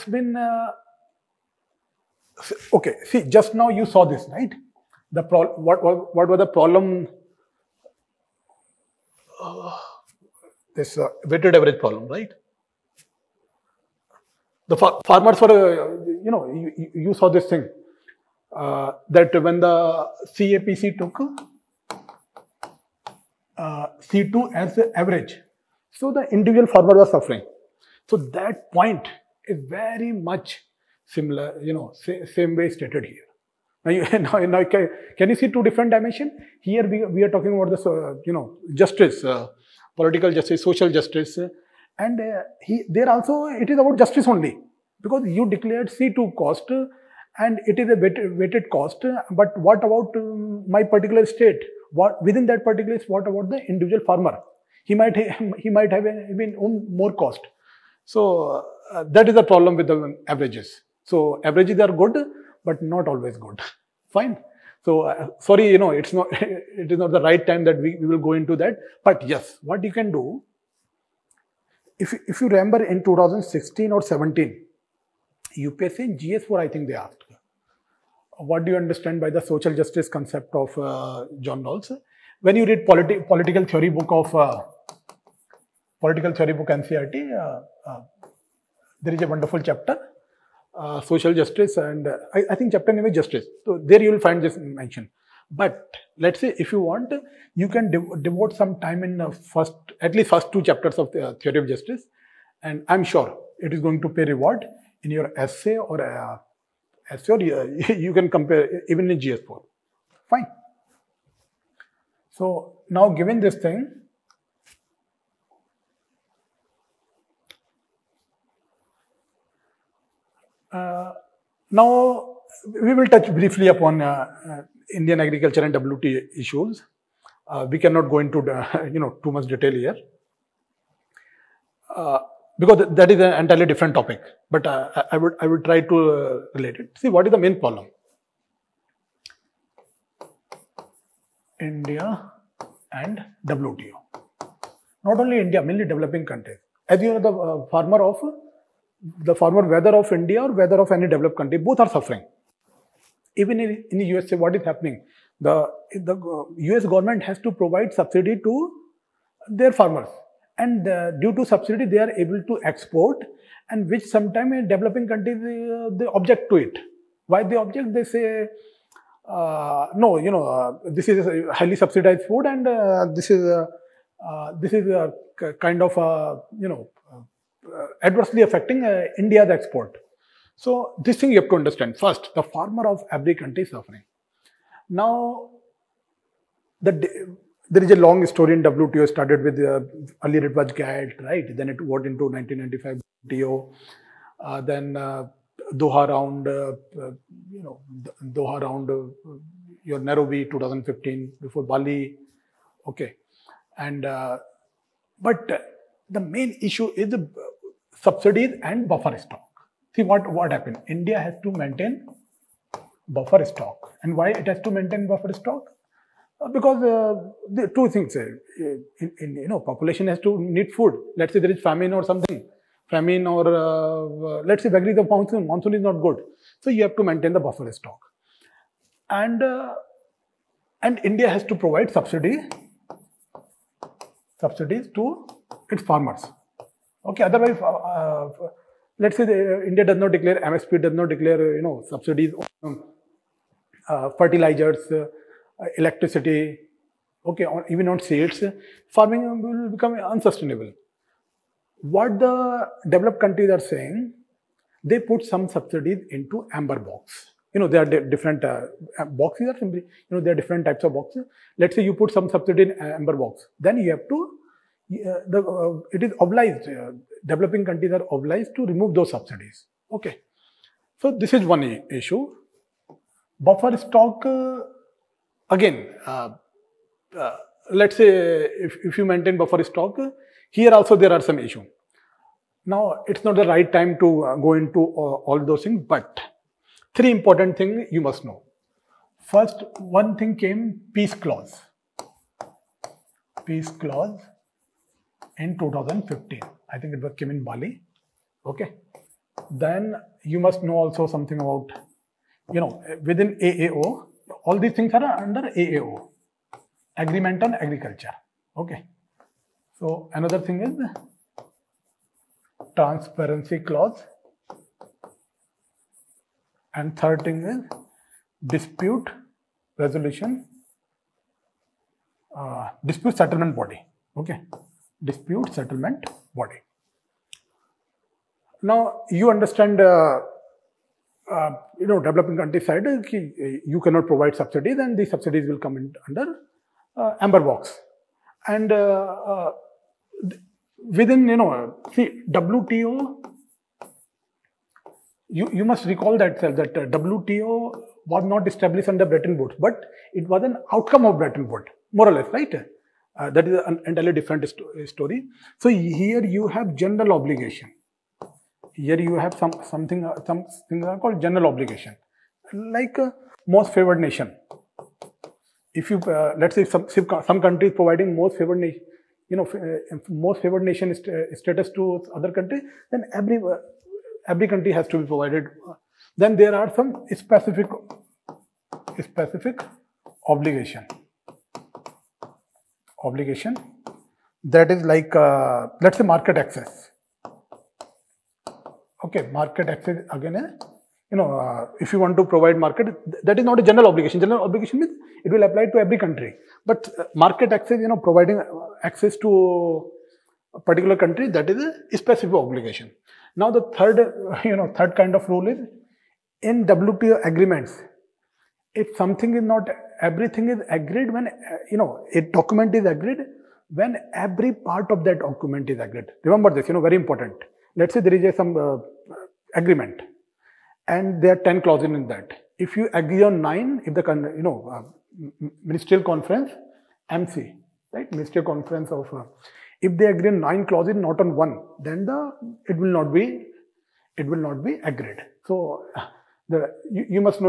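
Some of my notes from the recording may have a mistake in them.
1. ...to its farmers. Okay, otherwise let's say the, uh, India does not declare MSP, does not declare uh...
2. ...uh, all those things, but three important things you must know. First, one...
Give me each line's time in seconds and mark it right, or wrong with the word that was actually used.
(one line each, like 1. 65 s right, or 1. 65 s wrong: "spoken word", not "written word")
1. 234 s right
2. 284 s right.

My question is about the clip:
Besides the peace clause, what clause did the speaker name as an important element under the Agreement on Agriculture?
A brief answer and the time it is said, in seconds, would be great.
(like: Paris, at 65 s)
Transparency clause, at 312 s.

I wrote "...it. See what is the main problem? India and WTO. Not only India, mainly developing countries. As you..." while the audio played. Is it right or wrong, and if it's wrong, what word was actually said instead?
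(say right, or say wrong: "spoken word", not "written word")
right.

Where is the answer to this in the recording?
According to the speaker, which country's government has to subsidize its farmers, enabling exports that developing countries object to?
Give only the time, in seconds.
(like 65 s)
154 s.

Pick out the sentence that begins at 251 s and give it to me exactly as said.
What the developed countries are saying, they put some subsidies into amber box.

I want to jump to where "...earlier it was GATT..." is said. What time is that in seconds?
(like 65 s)
190 s.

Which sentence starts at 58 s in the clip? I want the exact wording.
So uh, that is the problem with the averages.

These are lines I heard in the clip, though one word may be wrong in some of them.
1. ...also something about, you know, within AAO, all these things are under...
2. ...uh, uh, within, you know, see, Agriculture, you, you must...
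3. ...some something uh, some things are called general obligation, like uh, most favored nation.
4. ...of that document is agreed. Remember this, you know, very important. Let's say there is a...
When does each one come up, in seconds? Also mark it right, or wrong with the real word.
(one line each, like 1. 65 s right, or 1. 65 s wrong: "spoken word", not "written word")
1. 300 s right
2. 338 s wrong: "WTO", not "Agriculture"
3. 359 s right
4. 414 s right.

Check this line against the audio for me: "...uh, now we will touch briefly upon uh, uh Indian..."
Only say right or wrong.
right.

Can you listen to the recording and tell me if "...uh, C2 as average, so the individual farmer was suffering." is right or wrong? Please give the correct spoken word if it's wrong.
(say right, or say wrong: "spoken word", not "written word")
right.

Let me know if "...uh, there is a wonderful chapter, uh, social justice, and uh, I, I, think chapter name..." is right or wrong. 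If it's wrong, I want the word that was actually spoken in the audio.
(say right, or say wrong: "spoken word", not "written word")
right.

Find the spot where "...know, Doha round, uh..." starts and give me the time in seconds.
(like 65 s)
197 s.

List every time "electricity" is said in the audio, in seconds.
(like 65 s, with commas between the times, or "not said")
245 s.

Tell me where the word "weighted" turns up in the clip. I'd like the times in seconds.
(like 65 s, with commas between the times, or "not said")
11 s, 48 s.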